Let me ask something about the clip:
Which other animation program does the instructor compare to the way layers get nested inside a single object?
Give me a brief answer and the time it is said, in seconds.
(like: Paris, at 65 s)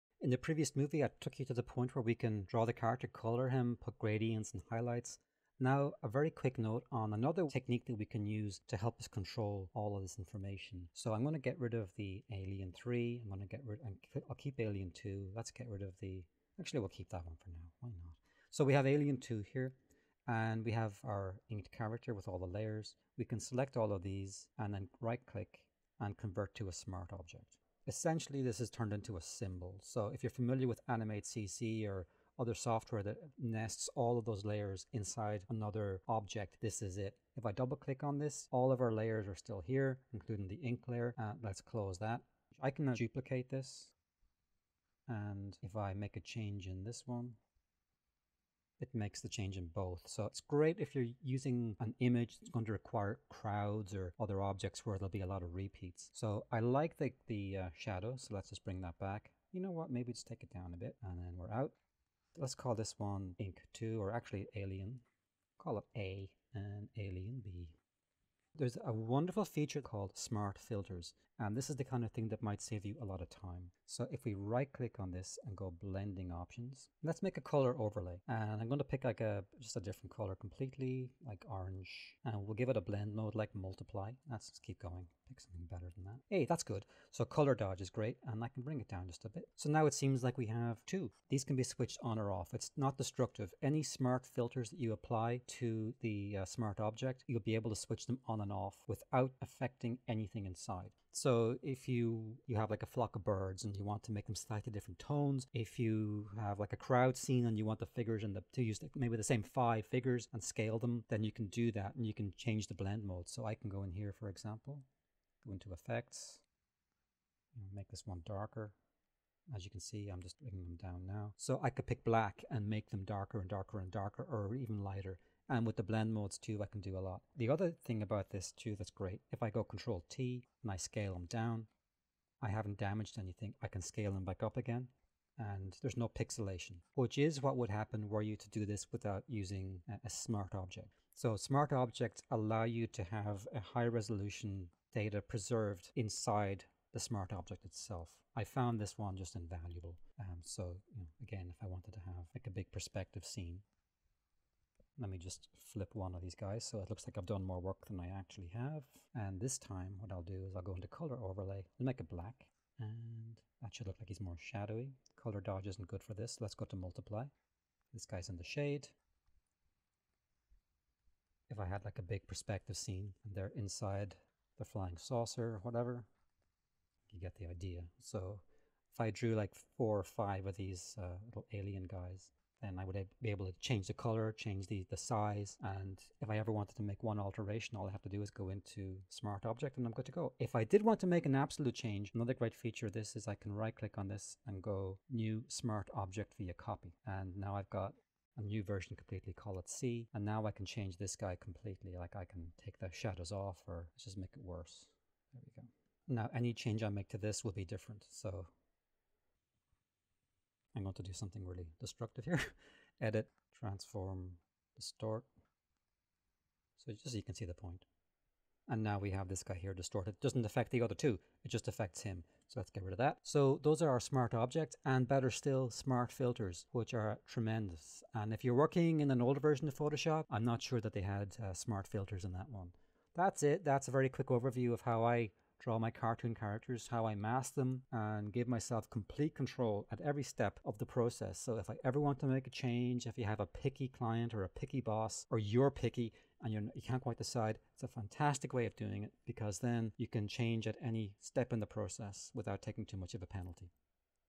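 Animate CC, at 30 s.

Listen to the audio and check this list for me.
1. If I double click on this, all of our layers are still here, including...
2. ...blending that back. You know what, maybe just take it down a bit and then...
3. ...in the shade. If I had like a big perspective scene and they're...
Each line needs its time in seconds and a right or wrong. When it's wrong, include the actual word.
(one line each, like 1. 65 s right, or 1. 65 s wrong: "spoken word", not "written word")
1. 37 s right
2. 58 s wrong: "bring", not "blending"
3. 168 s right.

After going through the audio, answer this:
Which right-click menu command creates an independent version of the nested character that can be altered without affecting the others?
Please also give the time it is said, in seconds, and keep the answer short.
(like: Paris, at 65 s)
New Smart Object via Copy, at 195 s.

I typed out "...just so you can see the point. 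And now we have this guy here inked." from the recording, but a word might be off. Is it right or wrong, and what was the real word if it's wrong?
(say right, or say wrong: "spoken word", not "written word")
wrong: "distorted", not "inked".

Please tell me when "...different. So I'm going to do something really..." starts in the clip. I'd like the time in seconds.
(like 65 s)
207 s.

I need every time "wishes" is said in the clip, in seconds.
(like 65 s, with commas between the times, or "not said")
not said.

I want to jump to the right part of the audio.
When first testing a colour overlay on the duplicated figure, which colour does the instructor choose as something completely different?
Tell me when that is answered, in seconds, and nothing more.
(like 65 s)
81 s.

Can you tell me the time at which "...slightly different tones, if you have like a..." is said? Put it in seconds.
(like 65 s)
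104 s.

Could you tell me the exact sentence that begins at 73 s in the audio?
So if we right click on this and go blending options, let's make a color overlay.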